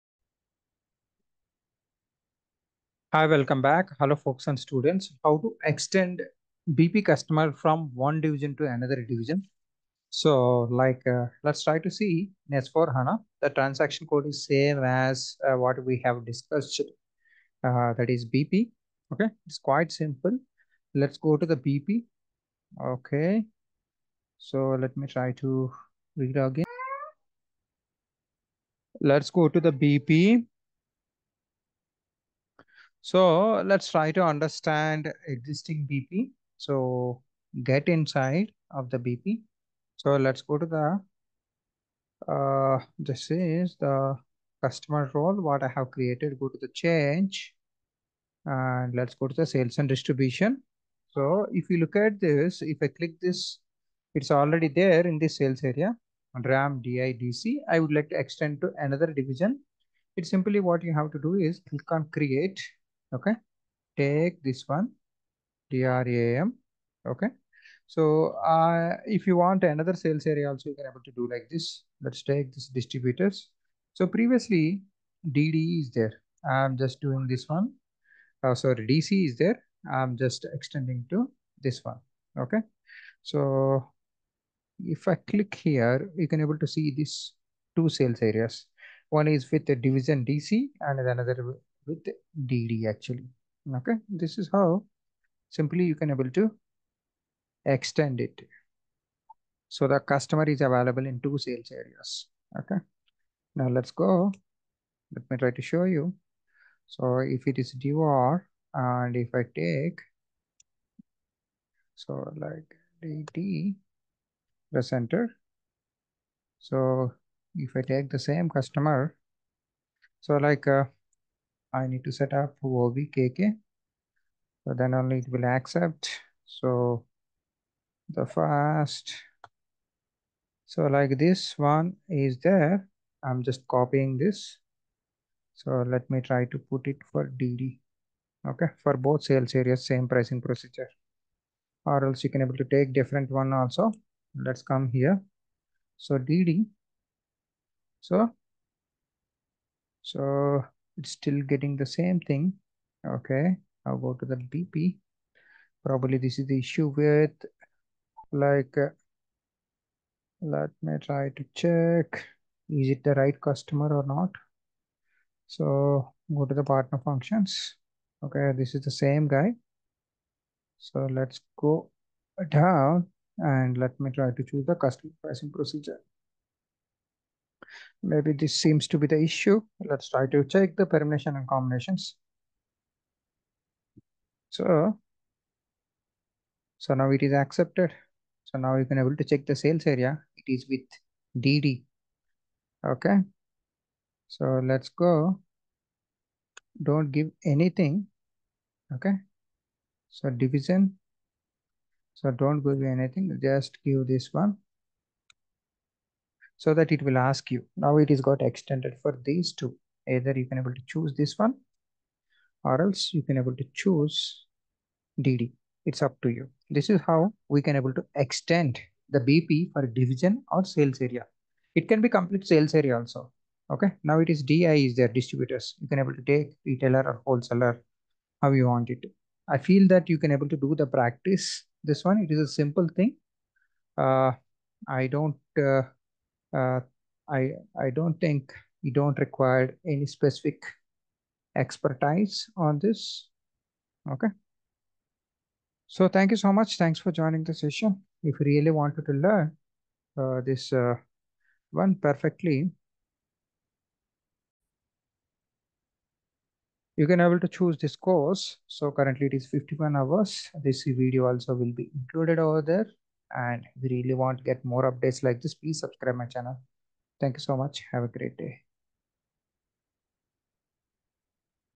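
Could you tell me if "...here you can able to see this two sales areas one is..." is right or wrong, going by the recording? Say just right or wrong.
right.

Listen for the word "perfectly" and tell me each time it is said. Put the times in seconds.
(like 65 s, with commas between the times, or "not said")
251 s.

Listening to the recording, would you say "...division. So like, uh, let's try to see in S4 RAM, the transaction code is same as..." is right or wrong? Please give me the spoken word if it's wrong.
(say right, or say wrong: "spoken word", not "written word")
wrong: "HANA", not "RAM".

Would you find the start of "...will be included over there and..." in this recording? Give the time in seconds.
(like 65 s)
261 s.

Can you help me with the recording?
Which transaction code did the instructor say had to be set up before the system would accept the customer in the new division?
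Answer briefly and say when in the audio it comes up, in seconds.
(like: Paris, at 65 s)
OVKK, at 122 s.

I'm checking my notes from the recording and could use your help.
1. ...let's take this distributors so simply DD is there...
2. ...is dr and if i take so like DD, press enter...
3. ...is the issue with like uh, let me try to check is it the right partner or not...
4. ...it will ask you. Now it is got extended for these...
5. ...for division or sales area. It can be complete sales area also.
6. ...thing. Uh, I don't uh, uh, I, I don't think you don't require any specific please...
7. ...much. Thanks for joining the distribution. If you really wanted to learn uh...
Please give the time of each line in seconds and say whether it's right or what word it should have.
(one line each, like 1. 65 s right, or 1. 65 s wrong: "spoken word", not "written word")
1. 72 s wrong: "previously", not "simply"
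2. 107 s right
3. 156 s wrong: "customer", not "partner"
4. 206 s right
5. 219 s right
6. 232 s wrong: "expertise", not "please"
7. 246 s wrong: "session", not "distribution".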